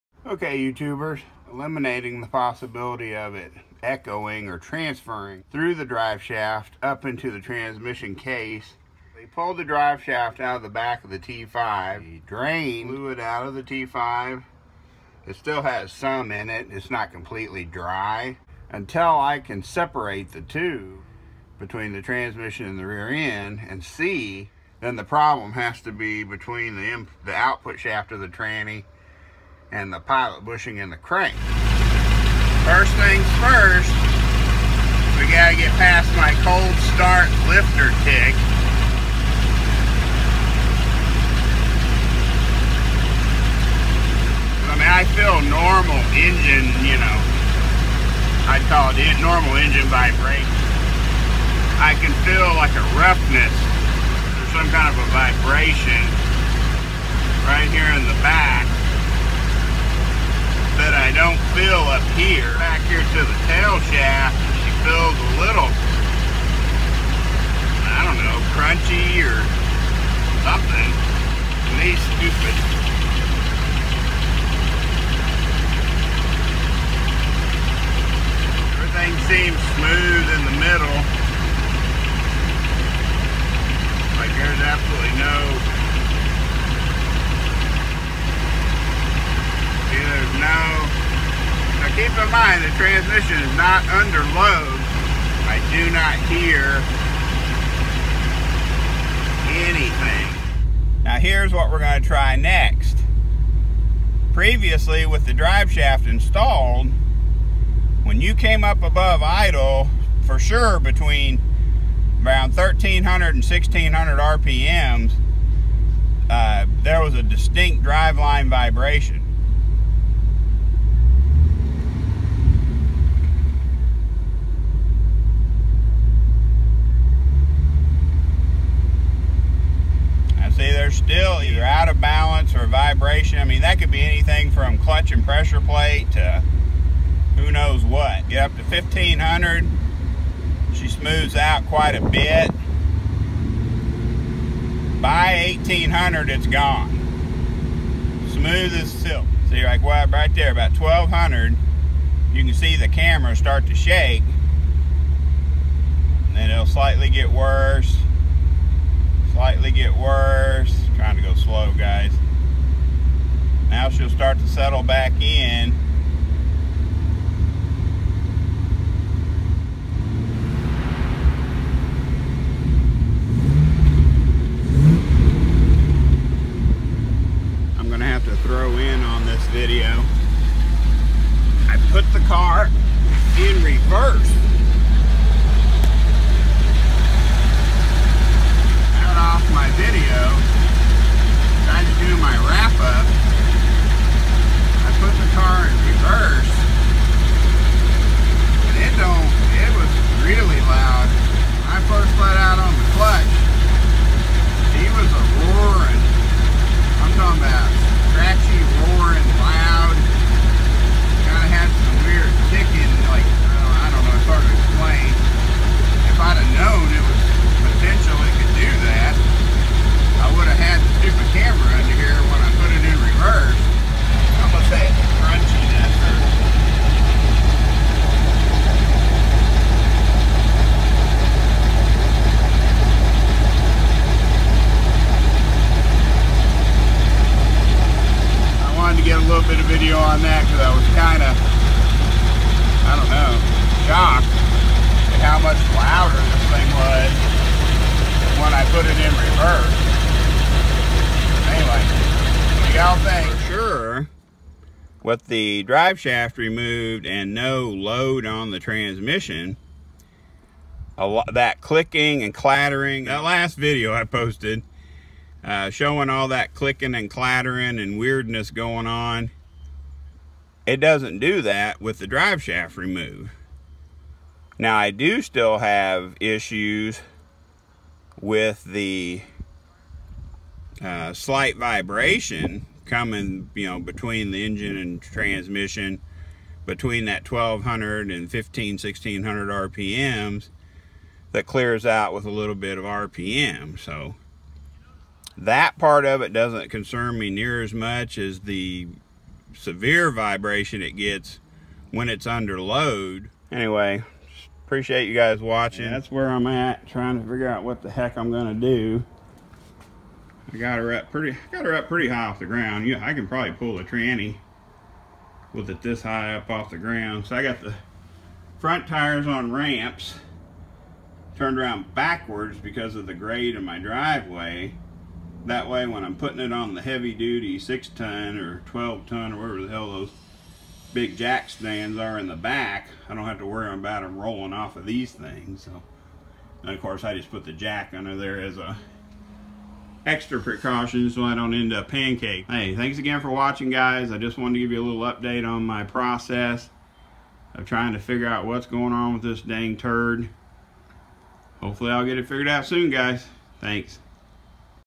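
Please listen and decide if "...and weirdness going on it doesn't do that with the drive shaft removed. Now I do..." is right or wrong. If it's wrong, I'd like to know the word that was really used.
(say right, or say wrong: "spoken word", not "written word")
right.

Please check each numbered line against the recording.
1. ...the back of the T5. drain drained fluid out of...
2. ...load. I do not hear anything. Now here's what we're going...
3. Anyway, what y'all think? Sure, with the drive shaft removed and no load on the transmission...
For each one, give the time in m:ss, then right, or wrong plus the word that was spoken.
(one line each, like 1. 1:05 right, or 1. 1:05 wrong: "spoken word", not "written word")
1. 0:10 right
2. 1:34 right
3. 4:11 right.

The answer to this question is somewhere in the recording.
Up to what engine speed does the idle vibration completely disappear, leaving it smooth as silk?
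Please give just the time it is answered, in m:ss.
2:25.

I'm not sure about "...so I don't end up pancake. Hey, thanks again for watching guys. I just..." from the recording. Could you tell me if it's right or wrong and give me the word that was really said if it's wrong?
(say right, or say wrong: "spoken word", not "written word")
right.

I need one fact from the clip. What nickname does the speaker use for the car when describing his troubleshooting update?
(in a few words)
turd.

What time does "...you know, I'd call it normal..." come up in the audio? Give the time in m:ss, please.
0:46.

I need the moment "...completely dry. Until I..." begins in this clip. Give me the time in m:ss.
0:17.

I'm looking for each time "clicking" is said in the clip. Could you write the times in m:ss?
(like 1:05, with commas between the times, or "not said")
4:21, 4:26.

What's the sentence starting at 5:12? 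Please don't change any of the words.
Yeah, I can probably pull a tranny with it this high up off the ground.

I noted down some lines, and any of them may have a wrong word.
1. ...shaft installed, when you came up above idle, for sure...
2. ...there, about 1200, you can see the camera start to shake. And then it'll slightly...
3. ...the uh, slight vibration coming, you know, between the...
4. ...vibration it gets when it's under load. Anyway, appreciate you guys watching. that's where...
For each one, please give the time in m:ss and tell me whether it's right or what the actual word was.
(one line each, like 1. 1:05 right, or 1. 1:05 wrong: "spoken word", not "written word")
1. 1:45 right
2. 2:30 right
3. 4:38 right
4. 5:00 right.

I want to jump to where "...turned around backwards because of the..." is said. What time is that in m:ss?
5:21.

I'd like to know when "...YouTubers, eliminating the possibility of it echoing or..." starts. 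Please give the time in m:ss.
0:00.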